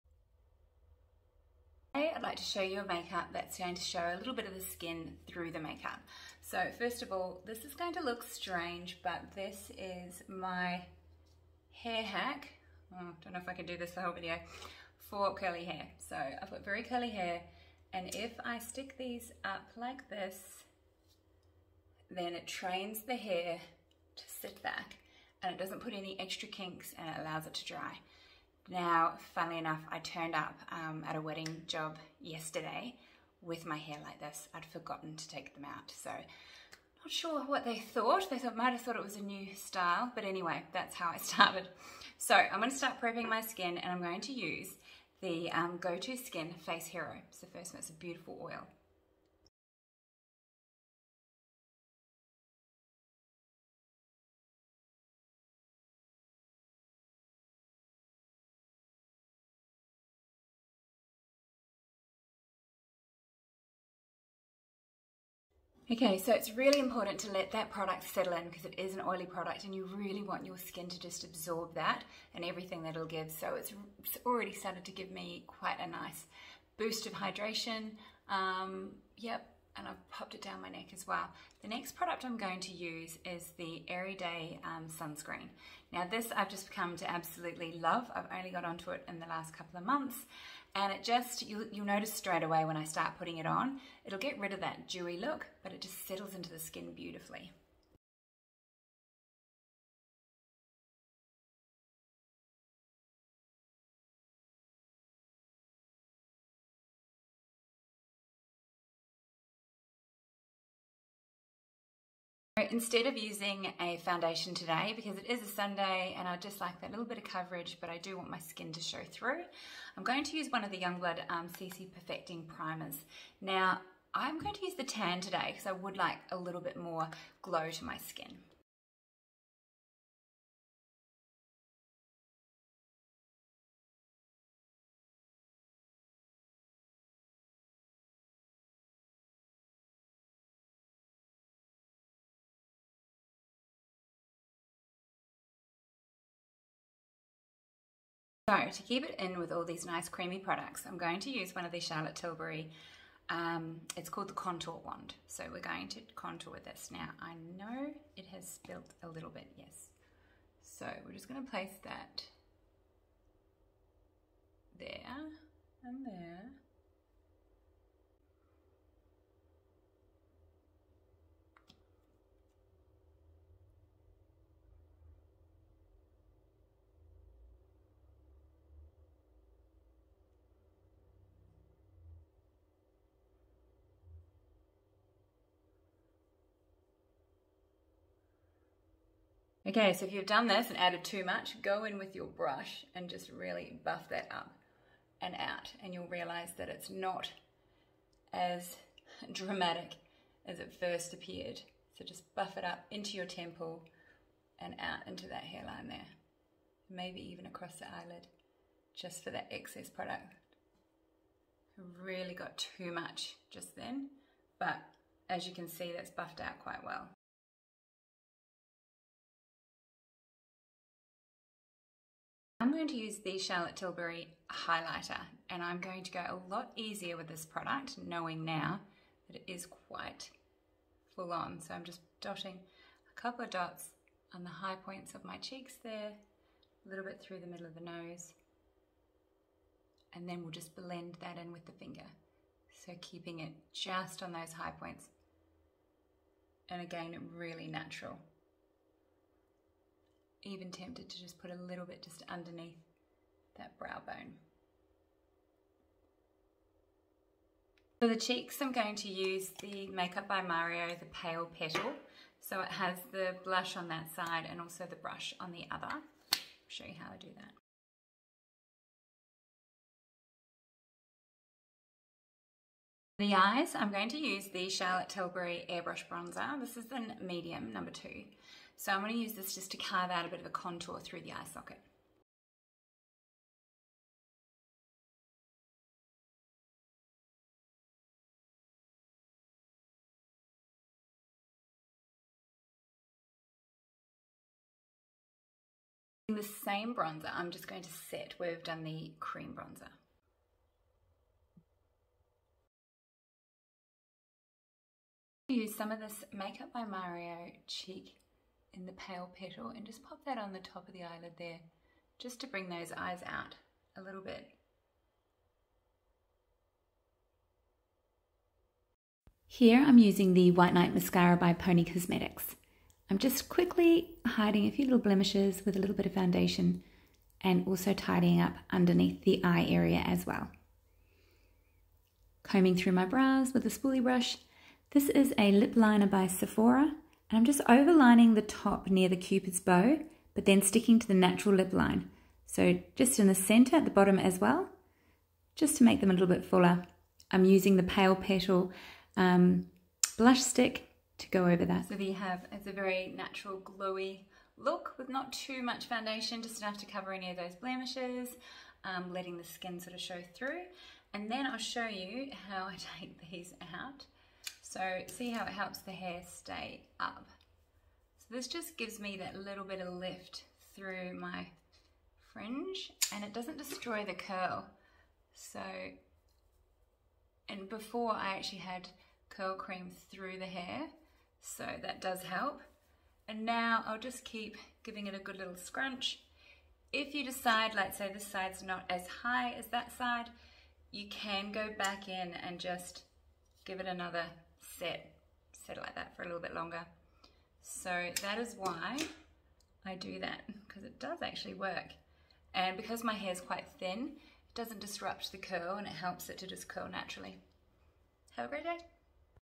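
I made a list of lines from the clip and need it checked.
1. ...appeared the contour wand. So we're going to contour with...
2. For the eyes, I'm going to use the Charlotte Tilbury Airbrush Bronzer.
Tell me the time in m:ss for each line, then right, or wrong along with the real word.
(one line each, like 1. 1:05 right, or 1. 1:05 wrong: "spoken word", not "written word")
1. 2:34 wrong: "called", not "appeared"
2. 4:33 right.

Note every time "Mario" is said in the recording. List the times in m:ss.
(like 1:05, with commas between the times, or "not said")
4:20, 5:06.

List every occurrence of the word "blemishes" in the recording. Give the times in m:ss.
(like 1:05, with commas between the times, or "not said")
5:24, 5:57.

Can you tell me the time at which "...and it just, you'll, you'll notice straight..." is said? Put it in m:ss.
1:30.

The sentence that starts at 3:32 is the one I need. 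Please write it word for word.
Really got too much just then, but as you can see, that's buffed out quite well.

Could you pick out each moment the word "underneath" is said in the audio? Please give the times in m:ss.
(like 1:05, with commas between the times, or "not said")
4:12, 5:28.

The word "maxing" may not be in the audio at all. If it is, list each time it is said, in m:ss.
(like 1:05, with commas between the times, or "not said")
not said.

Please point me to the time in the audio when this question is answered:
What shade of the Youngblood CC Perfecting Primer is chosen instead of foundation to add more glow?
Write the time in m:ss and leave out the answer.
2:04.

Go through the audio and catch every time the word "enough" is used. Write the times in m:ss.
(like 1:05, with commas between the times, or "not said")
0:29, 5:56.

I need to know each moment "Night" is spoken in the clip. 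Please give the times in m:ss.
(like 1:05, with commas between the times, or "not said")
5:20.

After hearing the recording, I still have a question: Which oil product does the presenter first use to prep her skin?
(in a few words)
Go-To Skin Face Hero.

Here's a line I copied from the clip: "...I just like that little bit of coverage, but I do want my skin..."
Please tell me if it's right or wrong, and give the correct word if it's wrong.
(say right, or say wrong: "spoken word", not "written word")
right.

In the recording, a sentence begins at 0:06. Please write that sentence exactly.
So first of all, this is going to look strange, but this is my hair hack.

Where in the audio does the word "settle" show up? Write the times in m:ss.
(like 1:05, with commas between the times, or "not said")
1:08, 1:36.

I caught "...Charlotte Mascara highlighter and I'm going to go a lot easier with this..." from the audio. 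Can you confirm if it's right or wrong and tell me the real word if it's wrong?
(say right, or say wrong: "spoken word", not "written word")
wrong: "Tilbury", not "Mascara".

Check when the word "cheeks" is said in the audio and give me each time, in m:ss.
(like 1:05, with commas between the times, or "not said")
3:55, 4:18, 5:07.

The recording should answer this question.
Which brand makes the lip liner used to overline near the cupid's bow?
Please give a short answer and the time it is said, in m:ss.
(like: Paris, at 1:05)
Sephora, at 5:36.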